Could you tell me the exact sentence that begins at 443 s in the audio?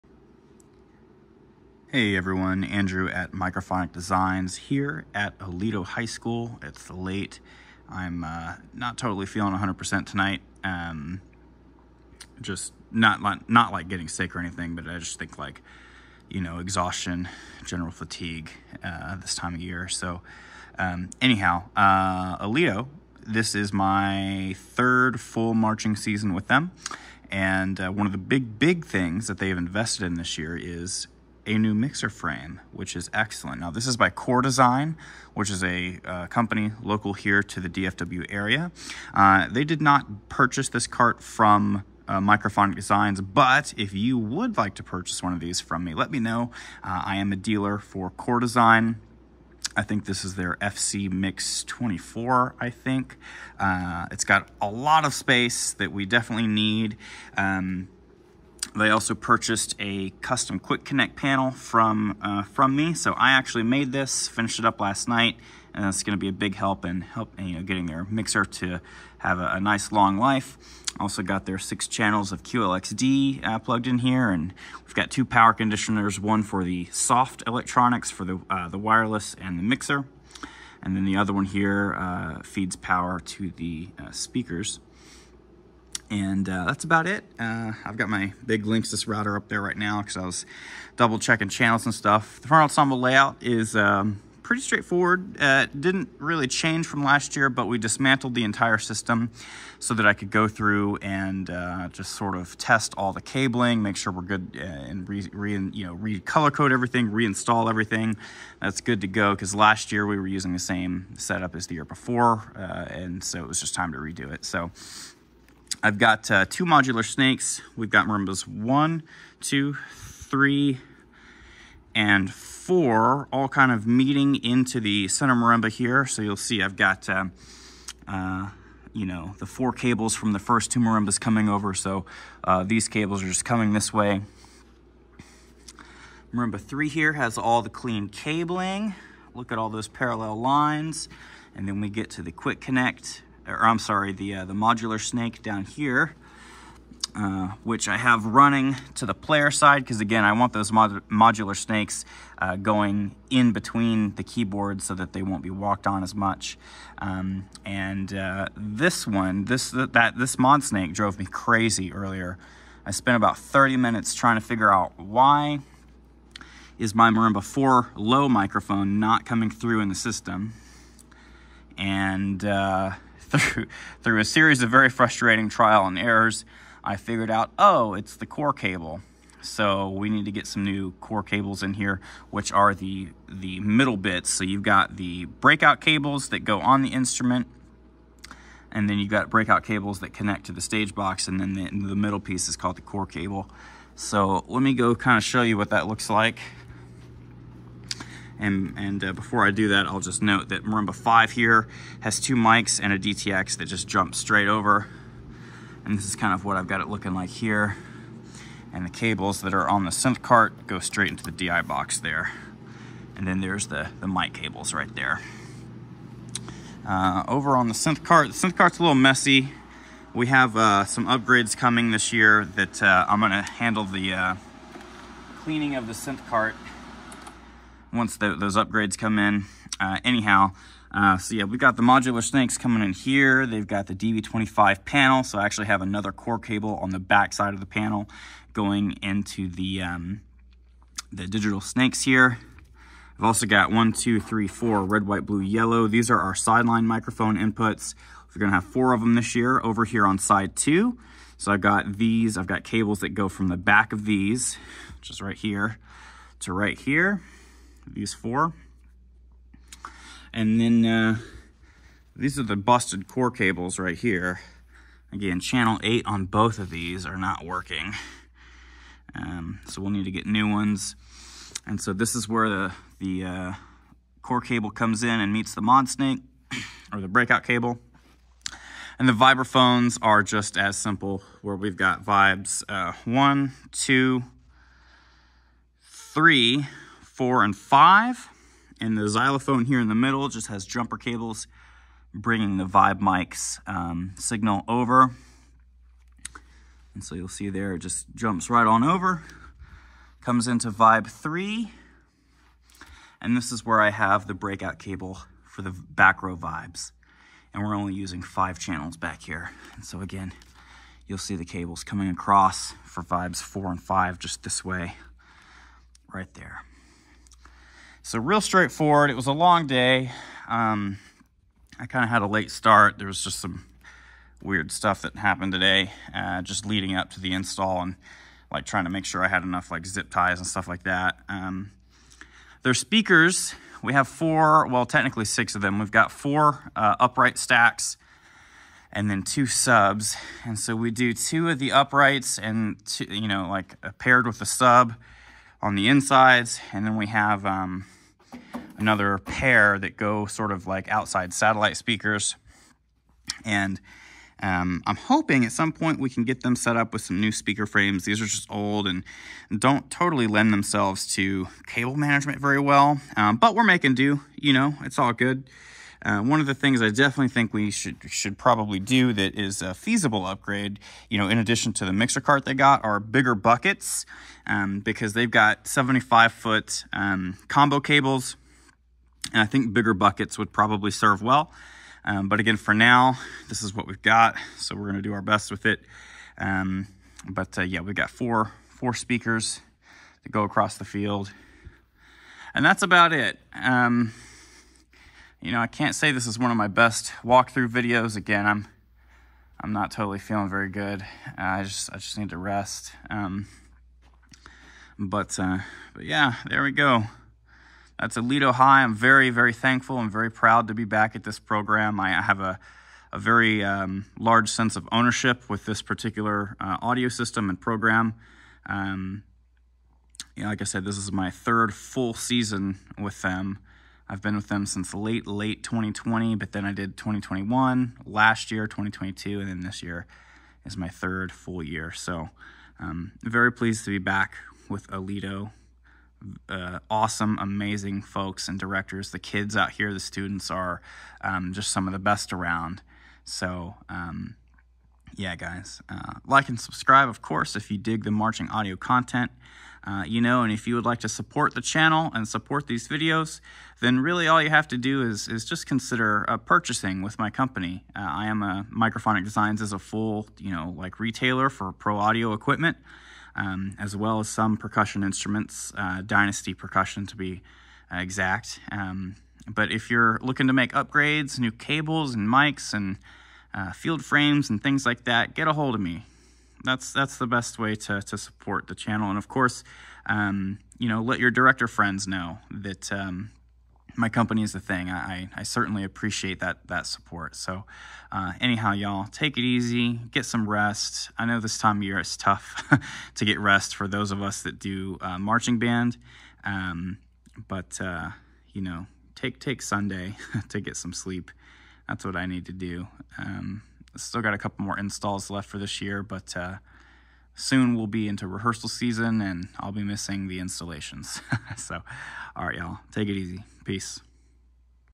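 So um, yeah, guys, uh, like and subscribe, of course, if you dig the marching audio content.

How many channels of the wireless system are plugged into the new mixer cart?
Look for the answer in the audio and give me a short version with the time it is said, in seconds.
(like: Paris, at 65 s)
6, at 71 s.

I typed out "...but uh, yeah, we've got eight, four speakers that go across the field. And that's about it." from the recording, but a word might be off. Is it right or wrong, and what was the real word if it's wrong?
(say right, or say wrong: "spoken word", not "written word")
wrong: "four", not "eight".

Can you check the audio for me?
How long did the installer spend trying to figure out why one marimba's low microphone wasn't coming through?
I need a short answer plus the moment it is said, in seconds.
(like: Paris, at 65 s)
30 minutes, at 163 s.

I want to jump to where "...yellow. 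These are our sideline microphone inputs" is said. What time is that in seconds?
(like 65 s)
245 s.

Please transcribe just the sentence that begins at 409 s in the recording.
I'm very proud to be back at this program.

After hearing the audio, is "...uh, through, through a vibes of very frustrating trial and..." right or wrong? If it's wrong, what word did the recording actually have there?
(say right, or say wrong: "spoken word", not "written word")
wrong: "series", not "vibes".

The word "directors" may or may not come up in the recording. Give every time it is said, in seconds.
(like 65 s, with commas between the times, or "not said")
438 s, 481 s.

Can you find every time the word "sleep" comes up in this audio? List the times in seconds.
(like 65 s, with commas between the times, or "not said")
500 s.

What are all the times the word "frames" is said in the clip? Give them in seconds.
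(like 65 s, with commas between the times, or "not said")
32 s, 357 s, 474 s.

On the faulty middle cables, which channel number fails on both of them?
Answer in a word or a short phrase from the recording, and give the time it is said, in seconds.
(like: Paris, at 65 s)
8, at 265 s.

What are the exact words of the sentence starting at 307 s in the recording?
And we're only using five channels back here.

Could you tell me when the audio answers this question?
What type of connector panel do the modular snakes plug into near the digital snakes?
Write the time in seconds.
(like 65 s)
233 s.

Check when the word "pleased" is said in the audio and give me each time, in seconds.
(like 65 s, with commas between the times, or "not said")
433 s.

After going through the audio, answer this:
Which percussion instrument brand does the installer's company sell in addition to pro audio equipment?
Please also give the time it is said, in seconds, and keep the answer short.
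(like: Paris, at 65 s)
Dynasty, at 466 s.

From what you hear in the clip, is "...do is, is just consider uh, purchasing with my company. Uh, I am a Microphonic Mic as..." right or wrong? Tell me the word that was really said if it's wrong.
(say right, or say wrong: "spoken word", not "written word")
wrong: "Designs", not "Mic".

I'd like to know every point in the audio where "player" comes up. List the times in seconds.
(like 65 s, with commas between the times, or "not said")
149 s.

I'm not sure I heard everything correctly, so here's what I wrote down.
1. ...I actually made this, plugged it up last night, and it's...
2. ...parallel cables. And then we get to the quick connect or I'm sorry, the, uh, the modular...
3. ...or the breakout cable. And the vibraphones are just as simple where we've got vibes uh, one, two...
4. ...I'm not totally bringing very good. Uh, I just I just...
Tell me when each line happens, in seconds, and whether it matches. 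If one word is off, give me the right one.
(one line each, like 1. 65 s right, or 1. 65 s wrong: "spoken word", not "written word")
1. 63 s wrong: "finished", not "plugged"
2. 139 s wrong: "lines", not "cables"
3. 276 s right
4. 399 s wrong: "feeling", not "bringing".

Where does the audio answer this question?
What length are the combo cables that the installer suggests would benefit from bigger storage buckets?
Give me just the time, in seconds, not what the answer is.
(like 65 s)
375 s.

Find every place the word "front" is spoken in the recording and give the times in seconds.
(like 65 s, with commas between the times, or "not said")
92 s.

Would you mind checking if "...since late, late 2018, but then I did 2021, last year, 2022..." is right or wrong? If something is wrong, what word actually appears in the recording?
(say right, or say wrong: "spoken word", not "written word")
wrong: "2020", not "2018".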